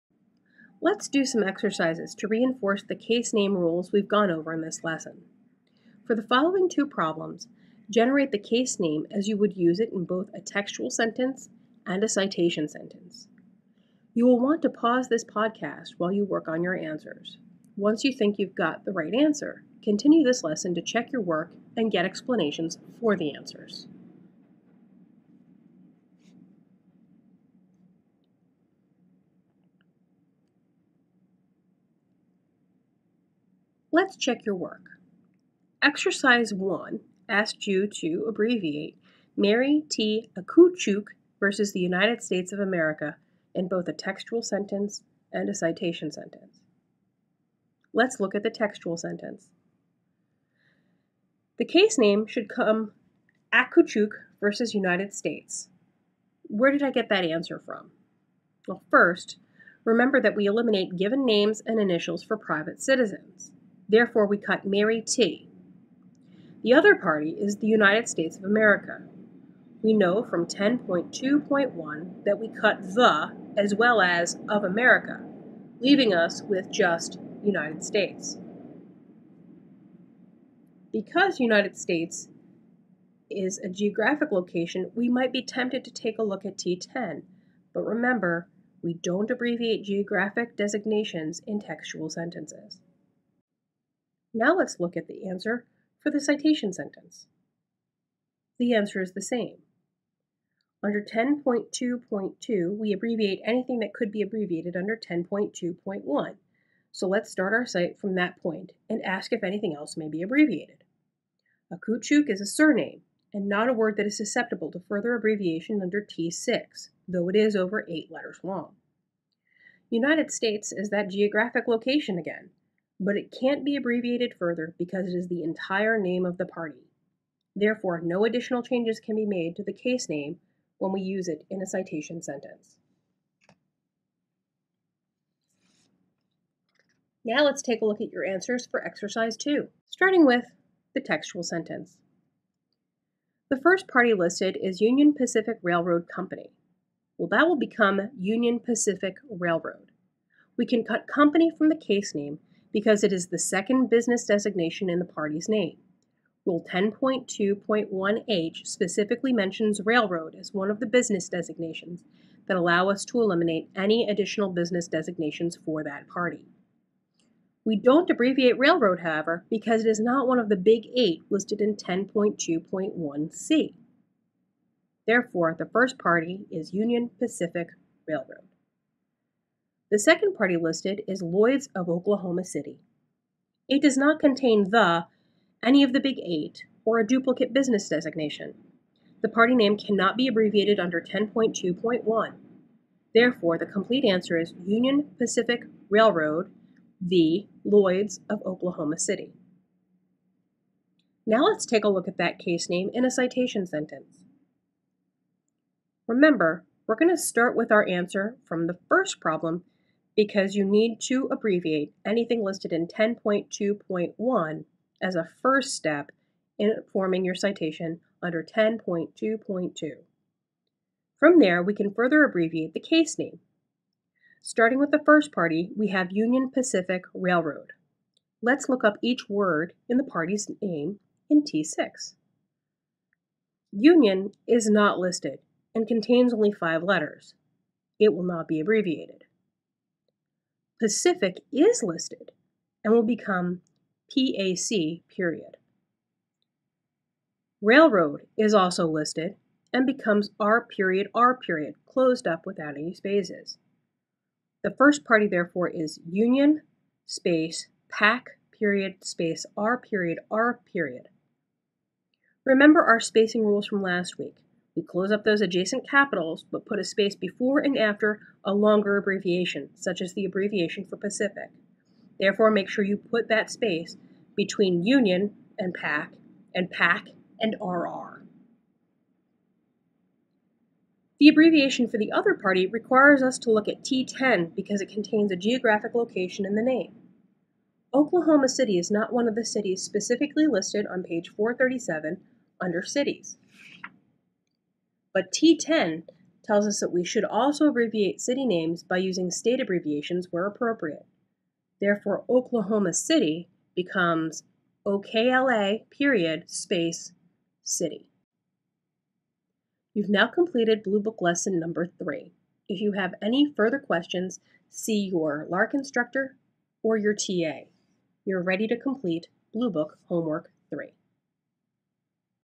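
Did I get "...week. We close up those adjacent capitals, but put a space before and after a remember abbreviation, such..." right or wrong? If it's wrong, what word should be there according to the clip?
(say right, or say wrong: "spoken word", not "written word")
wrong: "longer", not "remember".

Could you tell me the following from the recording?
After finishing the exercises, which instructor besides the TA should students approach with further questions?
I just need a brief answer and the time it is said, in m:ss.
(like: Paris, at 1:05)
LARC instructor, at 5:15.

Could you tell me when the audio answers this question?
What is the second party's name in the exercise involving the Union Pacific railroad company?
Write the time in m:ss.
3:01.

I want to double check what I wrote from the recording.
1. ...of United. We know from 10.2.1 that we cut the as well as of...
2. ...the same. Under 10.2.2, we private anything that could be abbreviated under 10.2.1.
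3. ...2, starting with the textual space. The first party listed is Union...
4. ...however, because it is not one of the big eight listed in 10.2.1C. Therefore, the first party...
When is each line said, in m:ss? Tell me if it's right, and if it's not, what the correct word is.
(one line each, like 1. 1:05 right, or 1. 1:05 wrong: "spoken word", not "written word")
1. 1:08 wrong: "America", not "United"
2. 1:39 wrong: "abbreviate", not "private"
3. 2:19 wrong: "sentence", not "space"
4. 2:49 right.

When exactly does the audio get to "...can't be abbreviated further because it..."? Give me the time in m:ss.
2:03.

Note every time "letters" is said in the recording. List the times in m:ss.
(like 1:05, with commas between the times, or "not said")
1:58, 3:56.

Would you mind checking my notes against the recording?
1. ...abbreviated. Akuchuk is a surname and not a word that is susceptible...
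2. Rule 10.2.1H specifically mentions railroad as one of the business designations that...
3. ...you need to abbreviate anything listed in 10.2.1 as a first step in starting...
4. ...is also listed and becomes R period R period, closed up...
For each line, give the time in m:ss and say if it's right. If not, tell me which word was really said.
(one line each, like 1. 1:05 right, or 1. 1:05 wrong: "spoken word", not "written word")
1. 1:50 right
2. 2:36 right
3. 3:30 wrong: "forming", not "starting"
4. 4:08 right.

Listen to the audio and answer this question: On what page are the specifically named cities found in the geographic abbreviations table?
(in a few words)
437.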